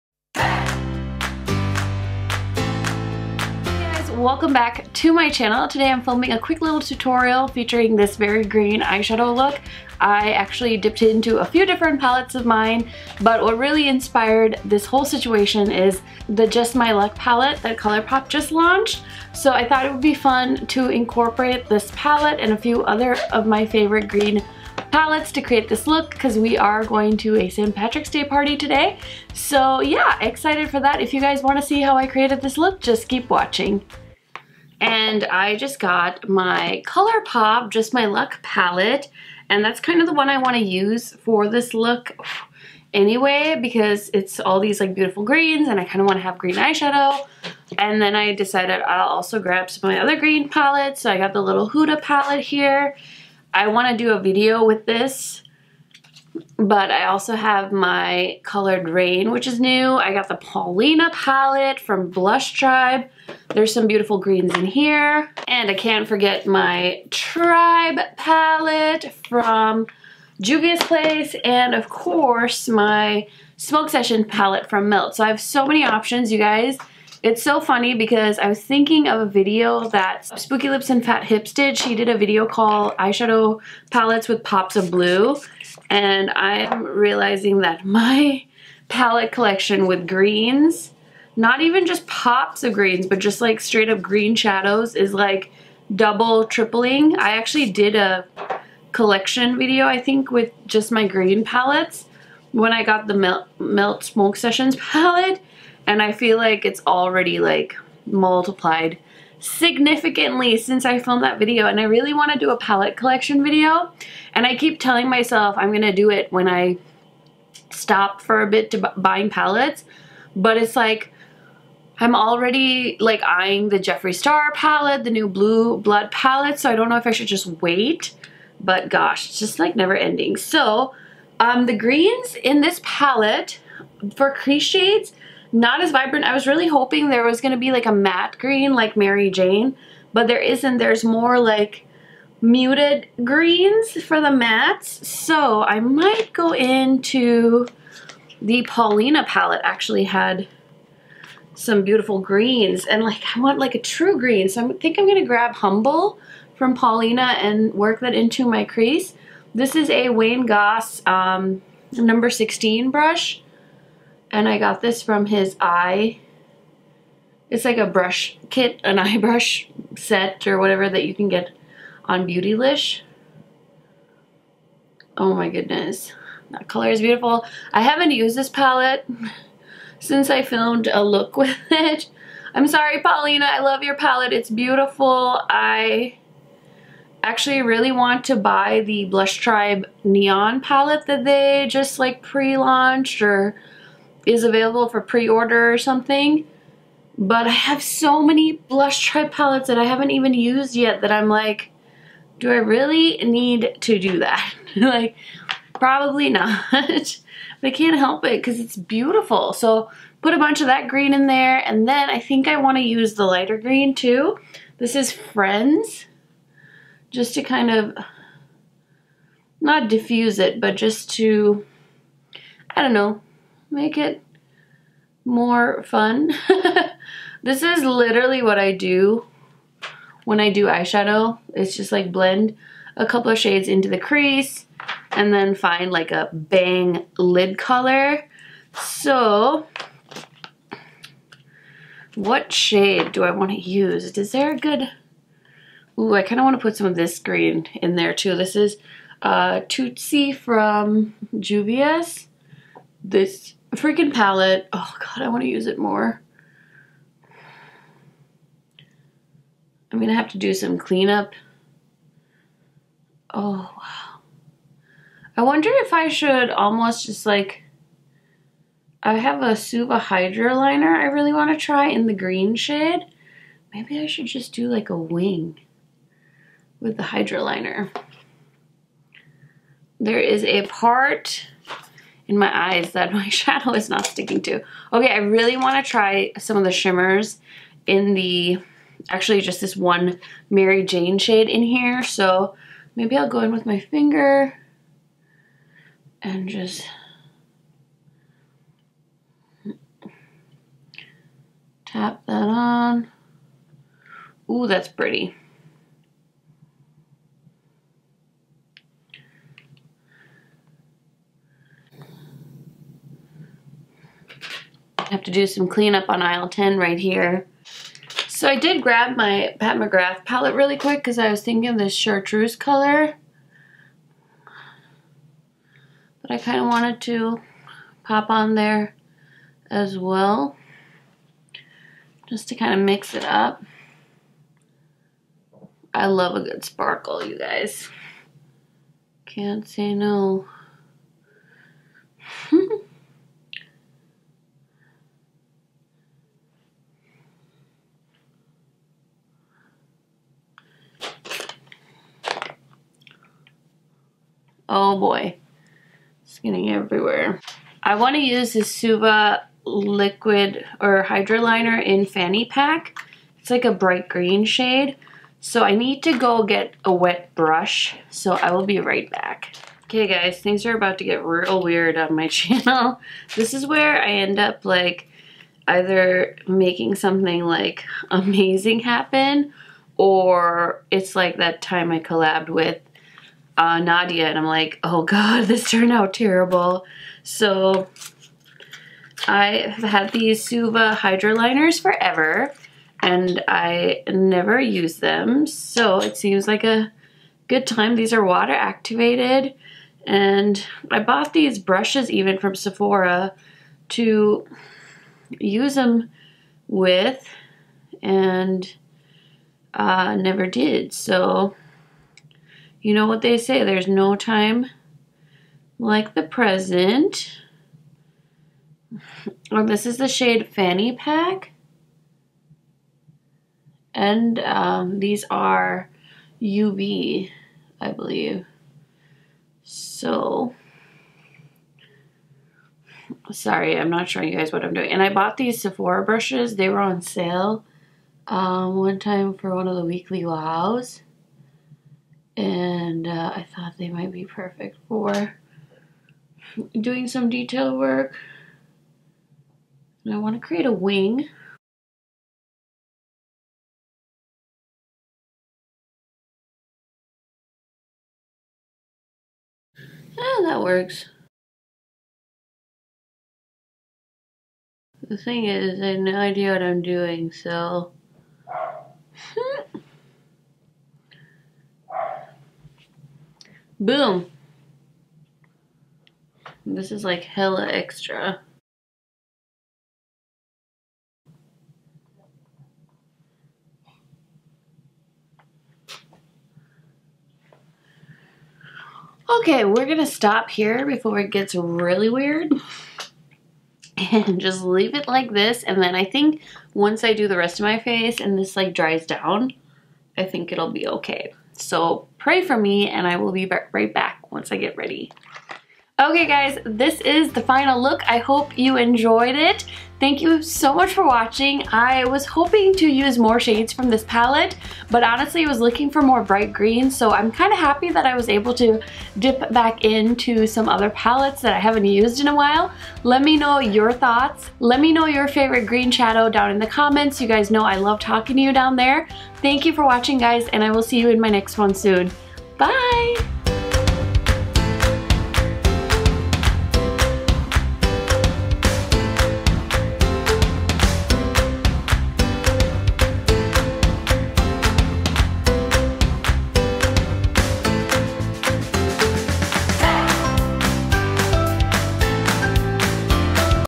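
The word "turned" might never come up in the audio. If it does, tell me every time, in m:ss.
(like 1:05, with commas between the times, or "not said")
6:25.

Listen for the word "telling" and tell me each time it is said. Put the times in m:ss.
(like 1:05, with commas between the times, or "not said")
1:54.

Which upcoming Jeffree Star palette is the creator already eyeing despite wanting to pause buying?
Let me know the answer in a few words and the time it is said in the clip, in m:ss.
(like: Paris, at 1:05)
Blue Blood, at 2:05.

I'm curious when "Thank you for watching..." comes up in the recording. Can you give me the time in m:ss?
8:49.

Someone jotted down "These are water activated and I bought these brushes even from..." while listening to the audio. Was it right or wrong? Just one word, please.
right.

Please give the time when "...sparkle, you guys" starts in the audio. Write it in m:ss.
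5:36.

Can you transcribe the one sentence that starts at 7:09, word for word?
So, sorry, I'm not showing you guys what I'm doing.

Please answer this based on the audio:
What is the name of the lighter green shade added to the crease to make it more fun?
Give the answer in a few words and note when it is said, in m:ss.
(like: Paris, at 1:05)
Friends, at 3:35.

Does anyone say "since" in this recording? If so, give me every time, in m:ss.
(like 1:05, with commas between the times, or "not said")
1:50, 2:59.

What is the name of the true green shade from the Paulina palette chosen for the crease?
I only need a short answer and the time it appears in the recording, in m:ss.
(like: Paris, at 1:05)
Humble, at 2:35.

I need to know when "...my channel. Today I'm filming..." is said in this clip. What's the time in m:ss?
0:05.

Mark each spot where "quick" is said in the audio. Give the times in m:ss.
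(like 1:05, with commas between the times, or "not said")
0:06, 5:20.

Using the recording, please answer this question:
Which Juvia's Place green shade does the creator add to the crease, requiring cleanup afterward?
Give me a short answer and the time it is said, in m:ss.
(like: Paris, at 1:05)
Tootsie, at 4:09.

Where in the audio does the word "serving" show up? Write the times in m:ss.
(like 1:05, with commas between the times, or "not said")
not said.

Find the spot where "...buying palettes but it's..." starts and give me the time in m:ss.
1:58.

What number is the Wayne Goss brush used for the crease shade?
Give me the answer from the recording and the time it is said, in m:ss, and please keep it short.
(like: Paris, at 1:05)
16, at 2:42.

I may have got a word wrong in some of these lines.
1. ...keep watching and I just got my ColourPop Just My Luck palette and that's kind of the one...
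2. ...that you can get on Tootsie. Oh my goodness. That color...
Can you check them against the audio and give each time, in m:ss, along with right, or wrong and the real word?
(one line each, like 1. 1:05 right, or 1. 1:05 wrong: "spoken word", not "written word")
1. 0:33 right
2. 2:50 wrong: "Beautylish", not "Tootsie".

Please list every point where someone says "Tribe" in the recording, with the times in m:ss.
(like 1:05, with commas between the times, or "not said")
1:02, 1:07, 3:09, 3:19.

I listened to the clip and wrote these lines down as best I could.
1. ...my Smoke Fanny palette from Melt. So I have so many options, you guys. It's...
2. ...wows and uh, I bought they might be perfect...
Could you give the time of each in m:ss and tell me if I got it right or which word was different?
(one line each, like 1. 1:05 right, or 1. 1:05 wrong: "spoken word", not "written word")
1. 1:12 wrong: "Session", not "Fanny"
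2. 7:20 wrong: "thought", not "bought".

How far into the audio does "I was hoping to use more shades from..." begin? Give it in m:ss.
8:31.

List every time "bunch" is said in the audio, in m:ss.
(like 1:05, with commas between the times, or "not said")
3:30.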